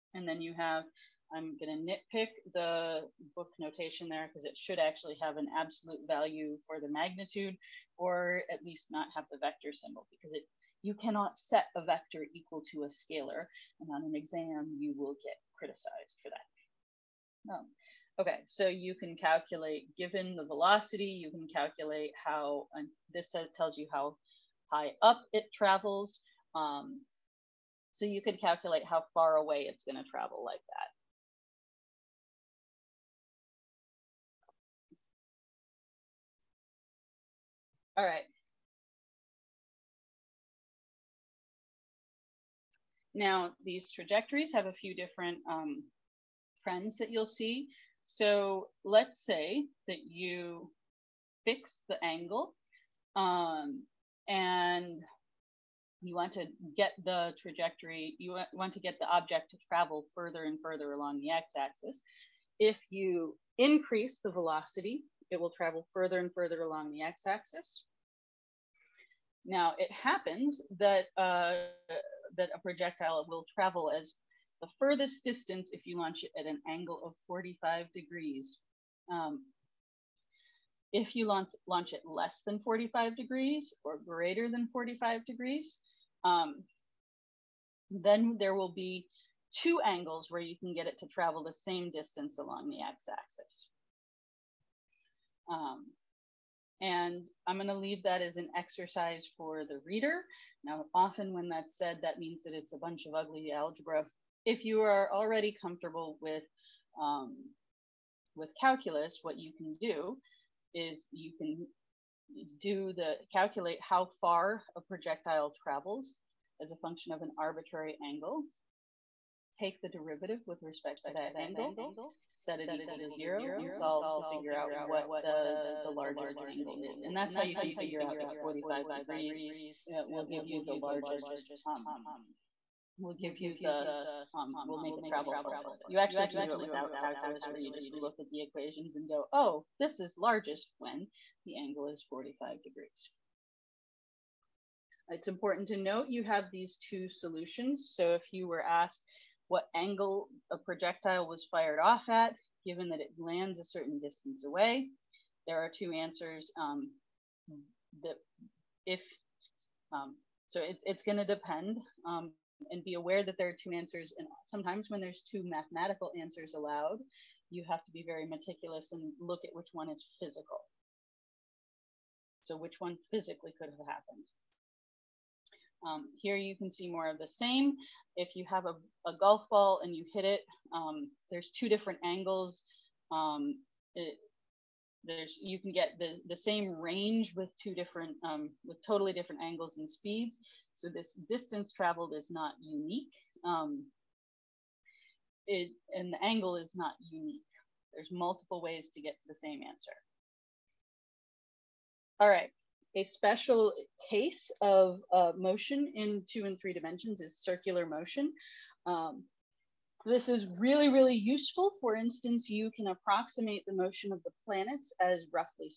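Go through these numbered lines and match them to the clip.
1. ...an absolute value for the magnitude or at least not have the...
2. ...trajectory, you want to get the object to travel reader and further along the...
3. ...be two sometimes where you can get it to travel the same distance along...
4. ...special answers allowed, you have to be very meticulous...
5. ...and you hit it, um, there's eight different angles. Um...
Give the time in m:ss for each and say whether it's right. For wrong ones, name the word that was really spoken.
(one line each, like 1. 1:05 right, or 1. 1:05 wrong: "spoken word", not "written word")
1. 0:05 right
2. 0:57 wrong: "further", not "reader"
3. 1:28 wrong: "angles", not "sometimes"
4. 2:45 wrong: "mathematical", not "special"
5. 2:59 wrong: "two", not "eight".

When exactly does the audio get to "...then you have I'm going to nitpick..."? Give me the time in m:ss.
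0:00.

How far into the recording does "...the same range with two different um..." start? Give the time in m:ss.
3:06.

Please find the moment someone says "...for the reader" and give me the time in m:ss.
1:39.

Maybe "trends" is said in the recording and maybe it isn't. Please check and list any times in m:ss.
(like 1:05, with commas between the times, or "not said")
0:46.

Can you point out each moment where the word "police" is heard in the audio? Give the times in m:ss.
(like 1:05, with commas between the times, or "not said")
not said.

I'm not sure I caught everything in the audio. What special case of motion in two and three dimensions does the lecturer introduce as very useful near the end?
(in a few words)
circular motion.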